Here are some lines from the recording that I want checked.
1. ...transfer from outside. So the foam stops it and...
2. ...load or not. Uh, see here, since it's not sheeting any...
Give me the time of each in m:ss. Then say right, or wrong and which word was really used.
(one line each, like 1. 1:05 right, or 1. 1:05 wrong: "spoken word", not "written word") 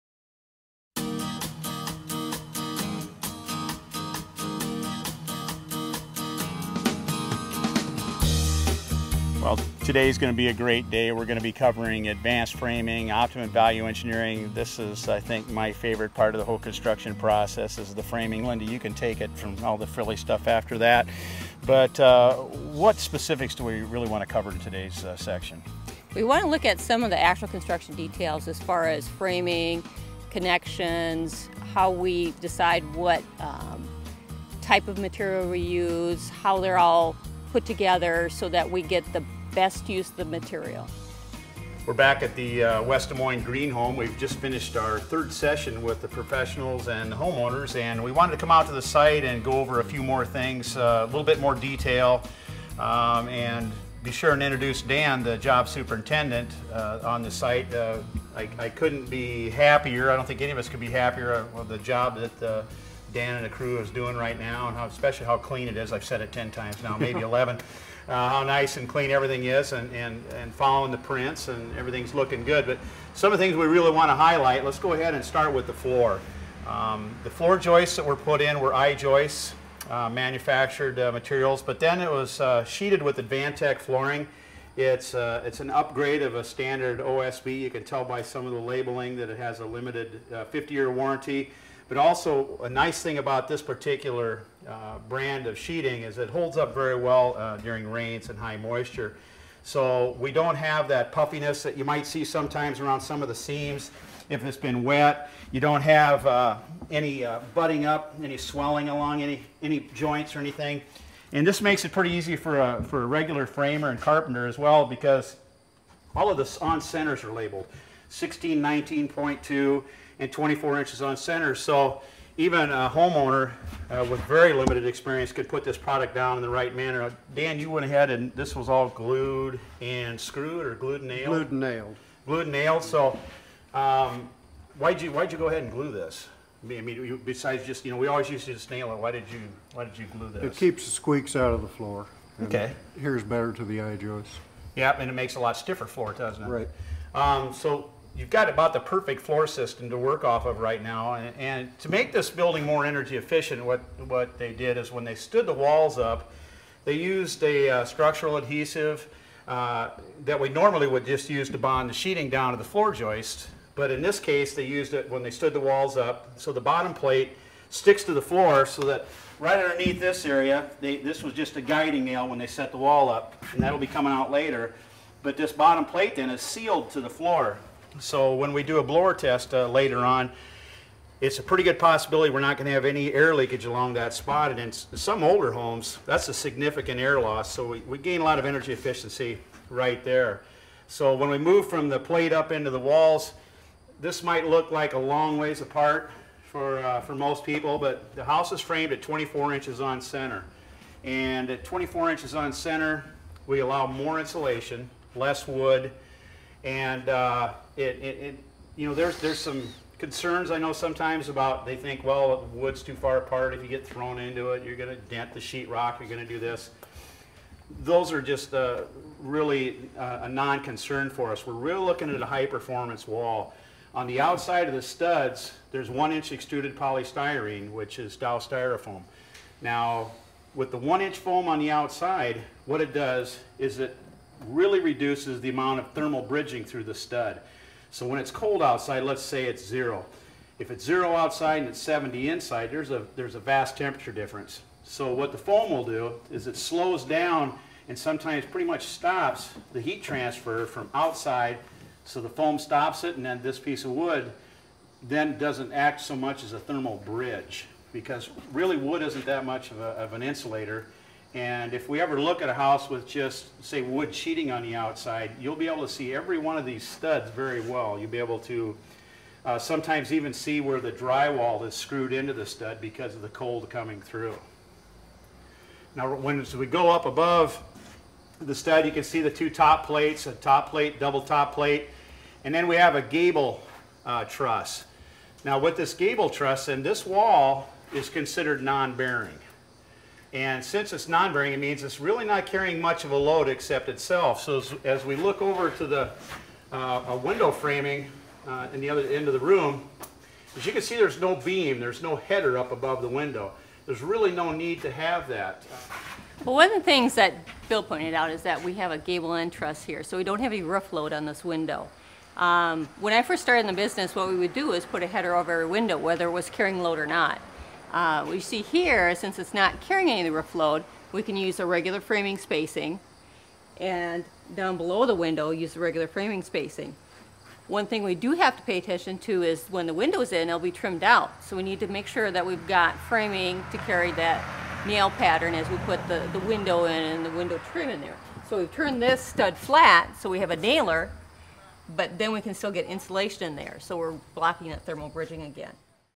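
1. 4:10 right
2. 5:16 wrong: "carrying", not "sheeting".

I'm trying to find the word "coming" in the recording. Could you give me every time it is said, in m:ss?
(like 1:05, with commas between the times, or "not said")
2:53, 4:33.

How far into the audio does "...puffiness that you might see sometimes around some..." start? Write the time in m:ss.
1:41.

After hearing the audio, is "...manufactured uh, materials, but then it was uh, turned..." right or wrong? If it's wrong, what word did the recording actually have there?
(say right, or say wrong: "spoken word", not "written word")
wrong: "sheeted", not "turned".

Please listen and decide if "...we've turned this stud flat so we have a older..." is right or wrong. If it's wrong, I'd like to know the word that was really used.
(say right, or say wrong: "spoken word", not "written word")
wrong: "nailer", not "older".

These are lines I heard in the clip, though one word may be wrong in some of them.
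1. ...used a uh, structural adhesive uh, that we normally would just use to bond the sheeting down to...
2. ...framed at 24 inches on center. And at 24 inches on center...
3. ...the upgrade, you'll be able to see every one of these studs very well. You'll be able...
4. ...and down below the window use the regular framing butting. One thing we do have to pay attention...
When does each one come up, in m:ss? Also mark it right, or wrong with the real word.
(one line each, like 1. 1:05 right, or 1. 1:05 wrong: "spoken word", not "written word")
1. 2:36 right
2. 3:18 right
3. 4:24 wrong: "outside", not "upgrade"
4. 5:23 wrong: "spacing", not "butting".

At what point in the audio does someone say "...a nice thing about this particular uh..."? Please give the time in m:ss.
1:32.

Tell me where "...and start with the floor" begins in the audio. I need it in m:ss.
1:15.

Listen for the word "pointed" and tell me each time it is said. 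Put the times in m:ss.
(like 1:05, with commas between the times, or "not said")
5:07.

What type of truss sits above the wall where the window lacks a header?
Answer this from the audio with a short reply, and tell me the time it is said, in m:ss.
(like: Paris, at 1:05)
Gable truss, at 4:43.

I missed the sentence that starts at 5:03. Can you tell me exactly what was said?
There's really no need to have that.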